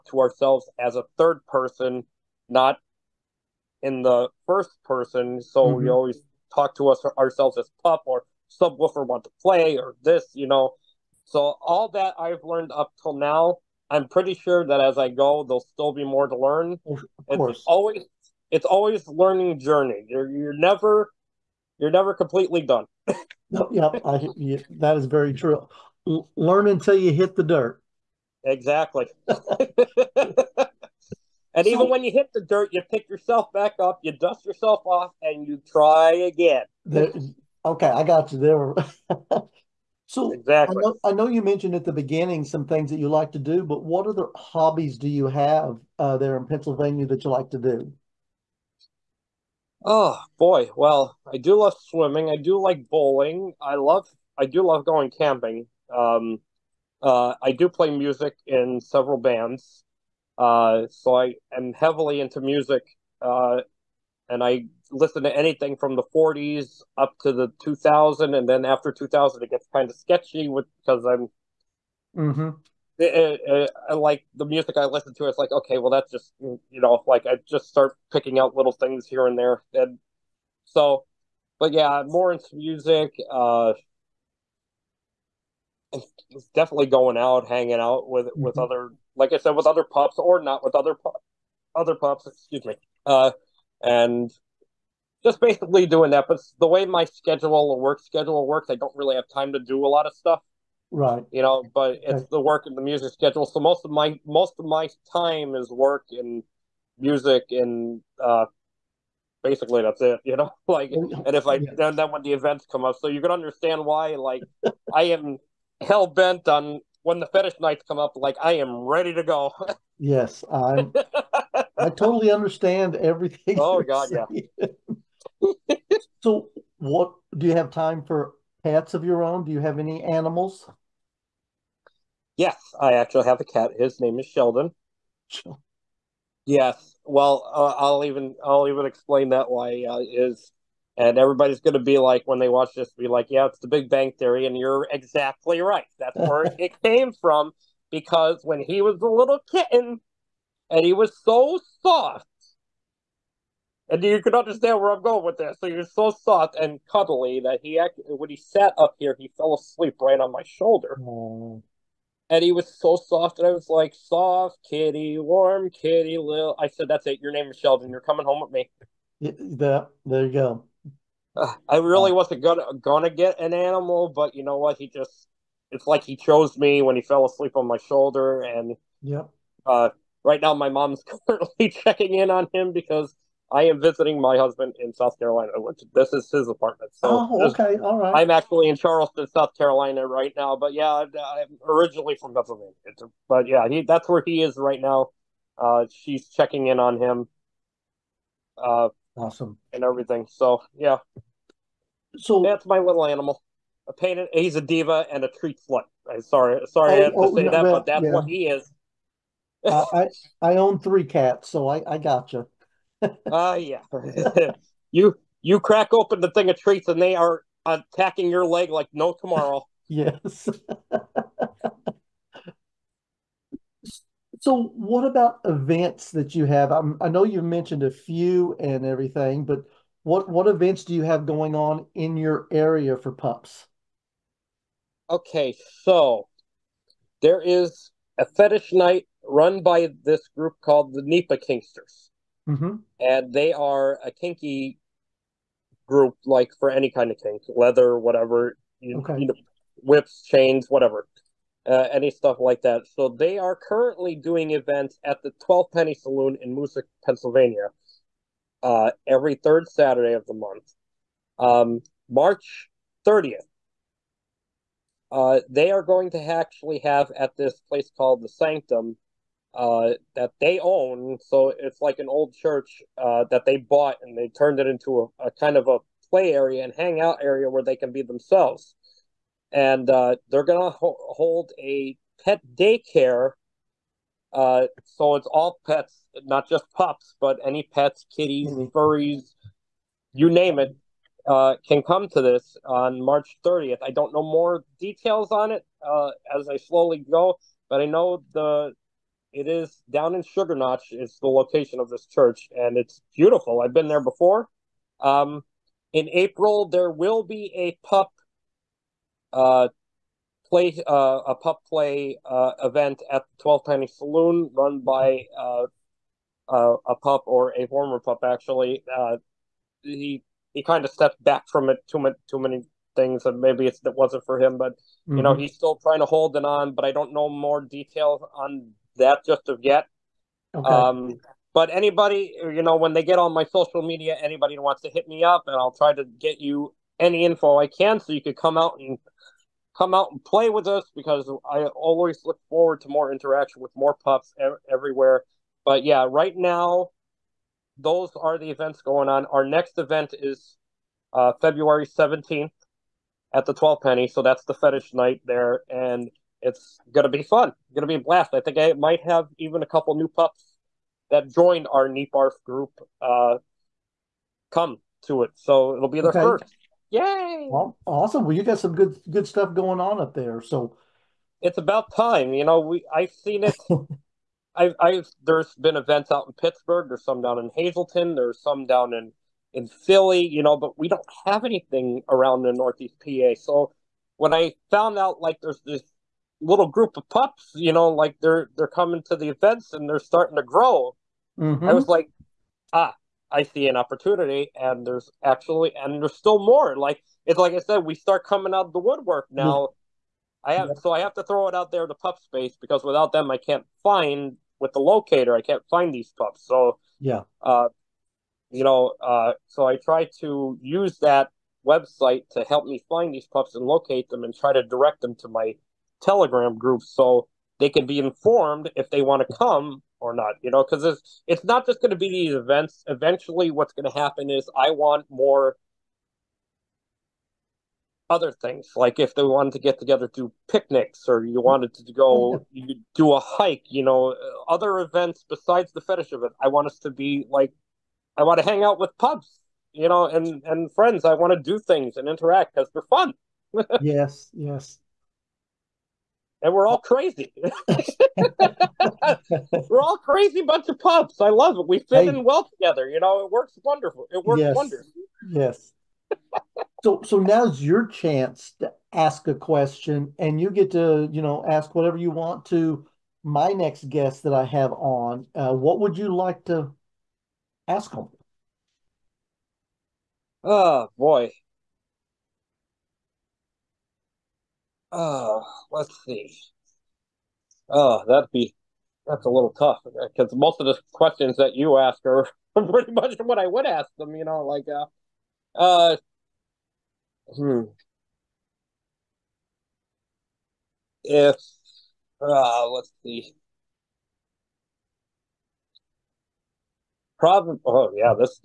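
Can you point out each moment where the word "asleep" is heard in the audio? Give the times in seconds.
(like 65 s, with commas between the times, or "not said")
159 s, 177 s.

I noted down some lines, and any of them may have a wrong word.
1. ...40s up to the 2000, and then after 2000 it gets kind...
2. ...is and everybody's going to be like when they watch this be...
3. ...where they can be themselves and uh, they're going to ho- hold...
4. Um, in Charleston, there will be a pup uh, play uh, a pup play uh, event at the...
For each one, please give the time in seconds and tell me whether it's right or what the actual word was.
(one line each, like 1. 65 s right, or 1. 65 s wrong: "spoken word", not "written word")
1. 66 s right
2. 140 s right
3. 277 s right
4. 305 s wrong: "April", not "Charleston".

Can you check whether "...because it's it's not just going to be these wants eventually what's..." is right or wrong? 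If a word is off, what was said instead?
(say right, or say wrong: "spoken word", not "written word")
wrong: "events", not "wants".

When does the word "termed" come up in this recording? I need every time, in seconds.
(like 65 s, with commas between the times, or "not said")
not said.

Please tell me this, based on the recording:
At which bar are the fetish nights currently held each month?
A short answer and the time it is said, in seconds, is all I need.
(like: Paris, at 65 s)
Twelfth Penny Saloon, at 255 s.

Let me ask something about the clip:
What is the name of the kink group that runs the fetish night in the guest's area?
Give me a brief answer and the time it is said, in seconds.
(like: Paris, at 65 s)
NEPA Kinksters, at 241 s.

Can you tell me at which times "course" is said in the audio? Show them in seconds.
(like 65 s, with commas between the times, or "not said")
17 s.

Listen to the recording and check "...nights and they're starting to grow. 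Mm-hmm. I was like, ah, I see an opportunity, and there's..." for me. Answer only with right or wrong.
wrong.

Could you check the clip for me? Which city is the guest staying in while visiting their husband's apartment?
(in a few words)
Charleston.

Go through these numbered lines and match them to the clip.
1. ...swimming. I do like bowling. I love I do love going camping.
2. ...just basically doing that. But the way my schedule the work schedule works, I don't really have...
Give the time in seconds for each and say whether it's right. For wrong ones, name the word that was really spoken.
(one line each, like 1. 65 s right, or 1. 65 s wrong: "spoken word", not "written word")
1. 51 s right
2. 95 s right.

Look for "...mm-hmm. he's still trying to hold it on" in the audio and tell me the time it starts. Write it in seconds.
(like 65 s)
325 s.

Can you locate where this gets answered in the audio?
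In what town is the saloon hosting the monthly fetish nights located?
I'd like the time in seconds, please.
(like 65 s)
256 s.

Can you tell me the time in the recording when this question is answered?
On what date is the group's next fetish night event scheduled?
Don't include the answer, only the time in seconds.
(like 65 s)
351 s.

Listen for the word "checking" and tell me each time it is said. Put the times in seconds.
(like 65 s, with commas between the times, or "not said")
181 s, 196 s.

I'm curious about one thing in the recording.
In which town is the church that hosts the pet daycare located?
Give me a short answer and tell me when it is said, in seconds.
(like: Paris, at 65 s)
Sugar Notch, at 300 s.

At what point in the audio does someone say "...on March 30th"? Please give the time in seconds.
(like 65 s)
292 s.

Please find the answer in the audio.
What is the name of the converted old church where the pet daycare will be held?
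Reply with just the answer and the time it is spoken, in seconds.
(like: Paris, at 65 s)
the Sanctum, at 268 s.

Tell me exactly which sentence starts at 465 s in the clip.
Uh, what would you like to ask them?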